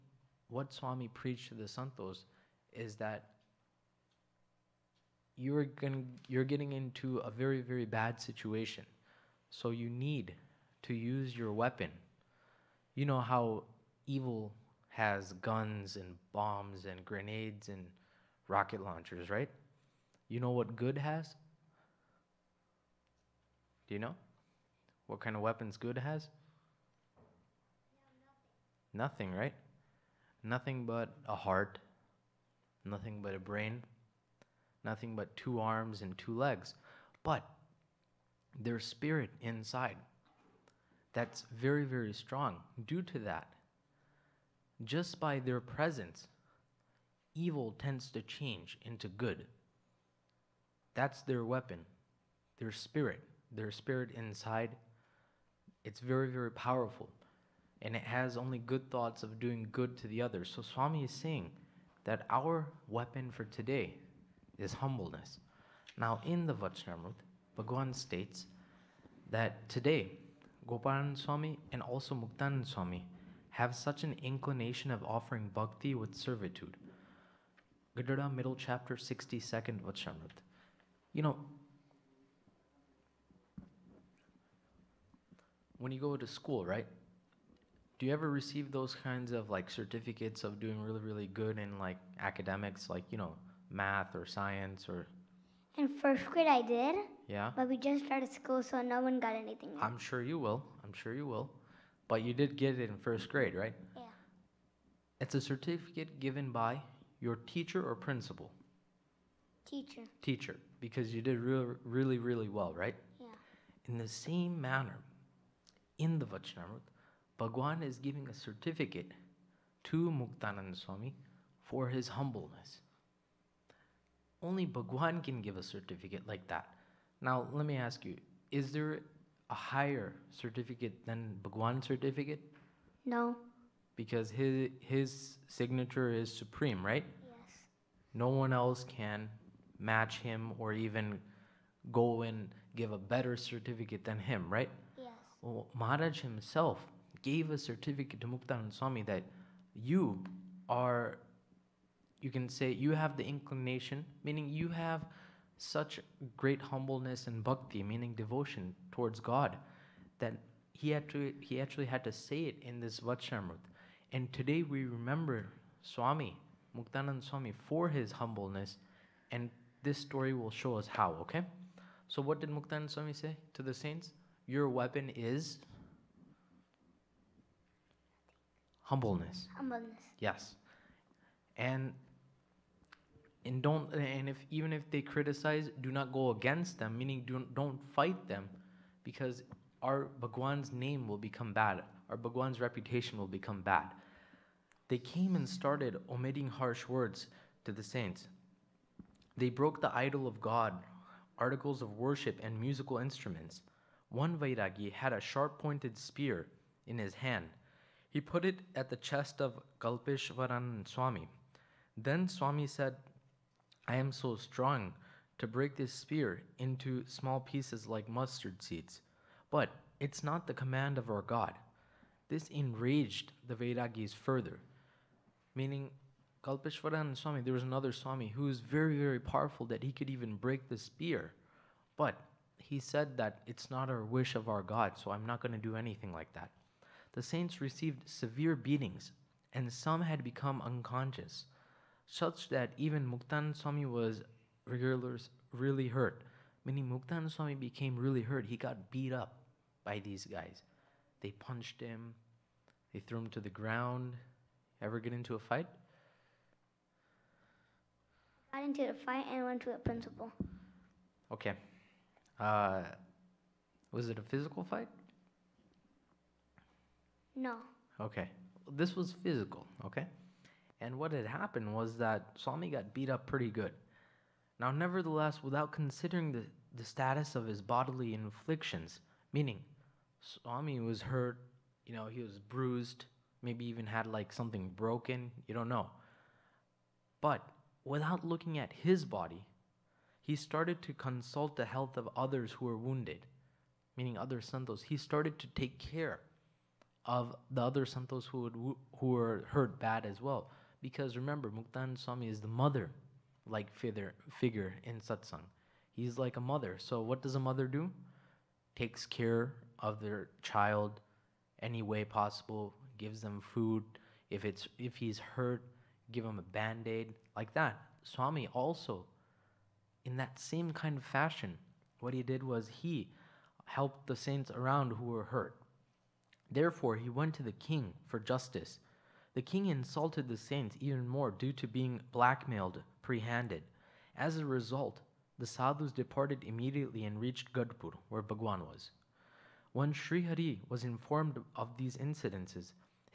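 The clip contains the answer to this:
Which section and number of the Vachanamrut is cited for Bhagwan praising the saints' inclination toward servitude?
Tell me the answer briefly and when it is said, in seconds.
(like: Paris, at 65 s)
Gadhada middle chapter 62, at 77 s.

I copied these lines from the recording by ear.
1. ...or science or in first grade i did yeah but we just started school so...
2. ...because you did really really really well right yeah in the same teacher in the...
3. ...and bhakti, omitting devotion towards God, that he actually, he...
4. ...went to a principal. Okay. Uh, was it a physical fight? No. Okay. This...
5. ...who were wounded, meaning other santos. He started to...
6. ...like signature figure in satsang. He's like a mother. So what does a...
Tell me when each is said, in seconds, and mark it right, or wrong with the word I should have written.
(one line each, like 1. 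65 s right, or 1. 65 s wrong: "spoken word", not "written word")
1. 94 s right
2. 110 s wrong: "manner", not "teacher"
3. 157 s wrong: "meaning", not "omitting"
4. 259 s right
5. 292 s right
6. 303 s wrong: "figure", not "signature".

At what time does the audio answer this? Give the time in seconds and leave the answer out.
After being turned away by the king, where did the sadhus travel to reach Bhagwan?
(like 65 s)
337 s.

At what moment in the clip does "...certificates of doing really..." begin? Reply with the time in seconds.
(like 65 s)
89 s.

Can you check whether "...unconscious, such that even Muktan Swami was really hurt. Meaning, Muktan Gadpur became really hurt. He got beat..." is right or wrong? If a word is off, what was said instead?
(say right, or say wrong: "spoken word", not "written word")
wrong: "Swami", not "Gadpur".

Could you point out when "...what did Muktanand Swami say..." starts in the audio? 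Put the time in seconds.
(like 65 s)
172 s.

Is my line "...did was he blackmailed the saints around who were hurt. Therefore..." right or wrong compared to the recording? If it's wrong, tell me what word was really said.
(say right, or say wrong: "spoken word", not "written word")
wrong: "helped", not "blackmailed".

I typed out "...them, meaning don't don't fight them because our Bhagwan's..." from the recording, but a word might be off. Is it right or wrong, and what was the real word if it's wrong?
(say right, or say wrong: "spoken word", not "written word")
right.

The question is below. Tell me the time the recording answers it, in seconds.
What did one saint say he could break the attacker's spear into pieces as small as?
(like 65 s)
218 s.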